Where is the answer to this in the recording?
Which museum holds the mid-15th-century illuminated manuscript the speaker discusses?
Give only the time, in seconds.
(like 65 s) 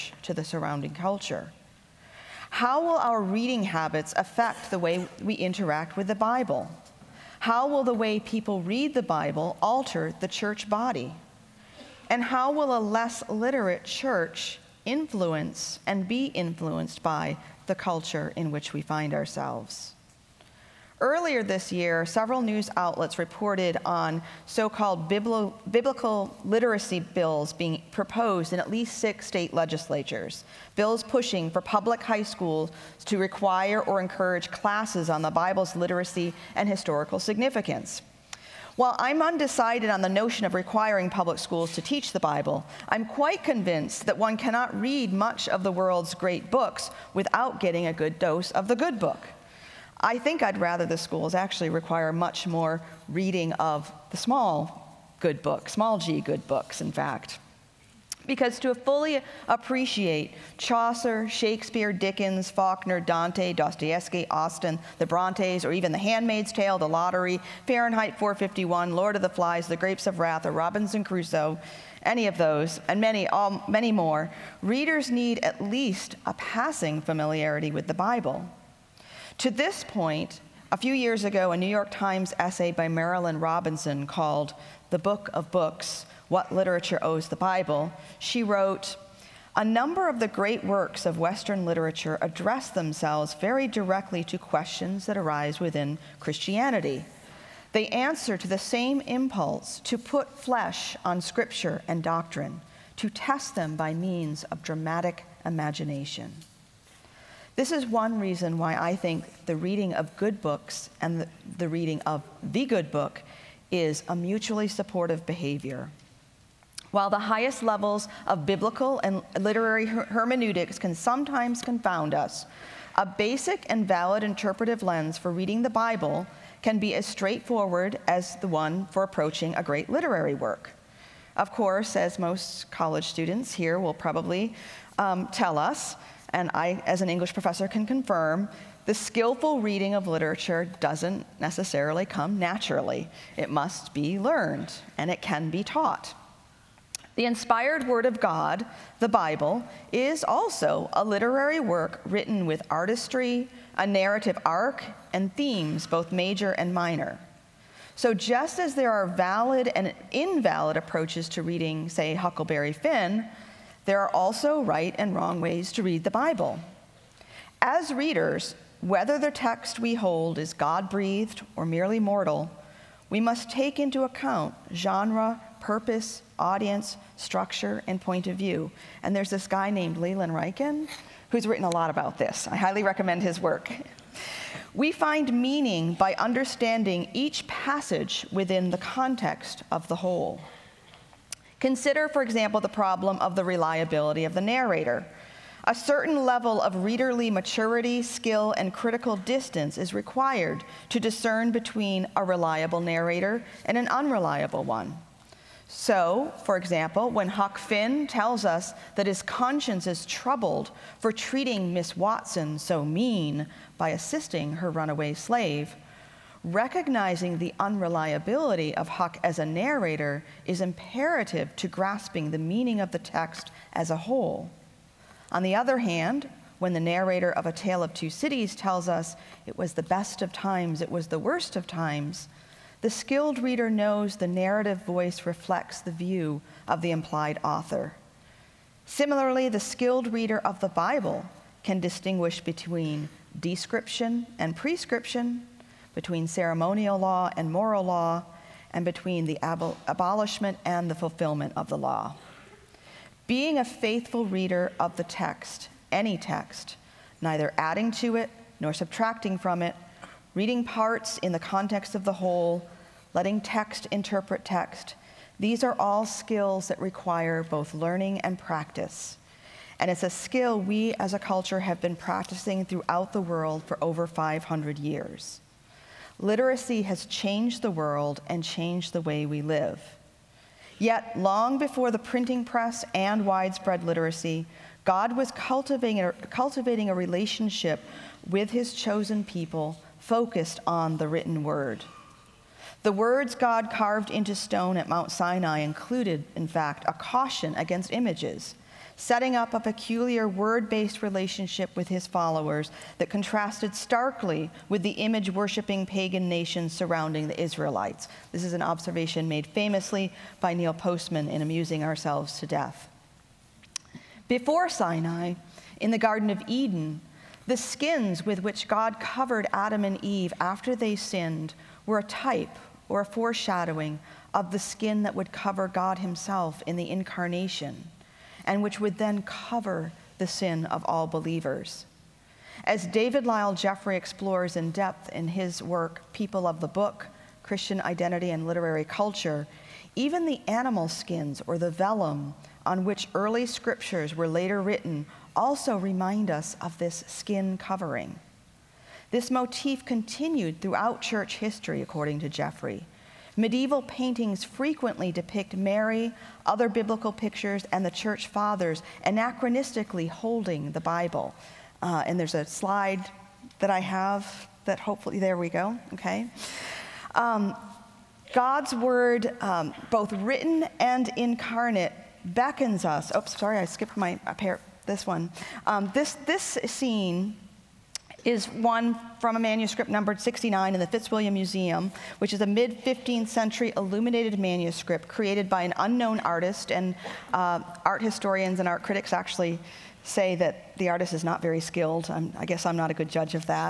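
380 s.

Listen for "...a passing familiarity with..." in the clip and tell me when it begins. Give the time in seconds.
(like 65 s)
76 s.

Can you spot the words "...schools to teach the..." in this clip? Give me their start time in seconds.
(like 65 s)
41 s.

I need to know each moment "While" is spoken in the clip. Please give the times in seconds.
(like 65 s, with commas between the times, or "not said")
38 s, 116 s.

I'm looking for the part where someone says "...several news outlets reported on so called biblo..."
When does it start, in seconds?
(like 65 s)
22 s.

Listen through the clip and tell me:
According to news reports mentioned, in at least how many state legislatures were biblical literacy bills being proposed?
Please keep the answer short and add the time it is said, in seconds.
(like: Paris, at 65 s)
6, at 28 s.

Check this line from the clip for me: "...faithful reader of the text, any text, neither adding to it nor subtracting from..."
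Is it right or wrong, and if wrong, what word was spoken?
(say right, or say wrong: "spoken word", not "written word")
right.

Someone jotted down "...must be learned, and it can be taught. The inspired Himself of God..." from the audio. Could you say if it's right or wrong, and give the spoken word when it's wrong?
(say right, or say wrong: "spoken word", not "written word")
wrong: "Word", not "Himself".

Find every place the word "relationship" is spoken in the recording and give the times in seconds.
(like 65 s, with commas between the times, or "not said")
286 s, 301 s.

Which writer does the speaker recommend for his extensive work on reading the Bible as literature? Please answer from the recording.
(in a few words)
Leland Ryken.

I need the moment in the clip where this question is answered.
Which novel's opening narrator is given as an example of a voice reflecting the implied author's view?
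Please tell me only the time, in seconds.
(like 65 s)
227 s.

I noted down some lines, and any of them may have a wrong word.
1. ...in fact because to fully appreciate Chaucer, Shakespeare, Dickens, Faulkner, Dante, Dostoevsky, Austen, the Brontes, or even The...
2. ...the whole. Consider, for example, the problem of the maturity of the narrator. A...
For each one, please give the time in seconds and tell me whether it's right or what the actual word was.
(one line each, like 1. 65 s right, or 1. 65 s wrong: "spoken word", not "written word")
1. 56 s right
2. 189 s wrong: "reliability", not "maturity".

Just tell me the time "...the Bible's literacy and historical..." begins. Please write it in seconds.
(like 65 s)
35 s.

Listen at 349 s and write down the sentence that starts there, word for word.
This motif continued throughout church history, according to Jeffrey.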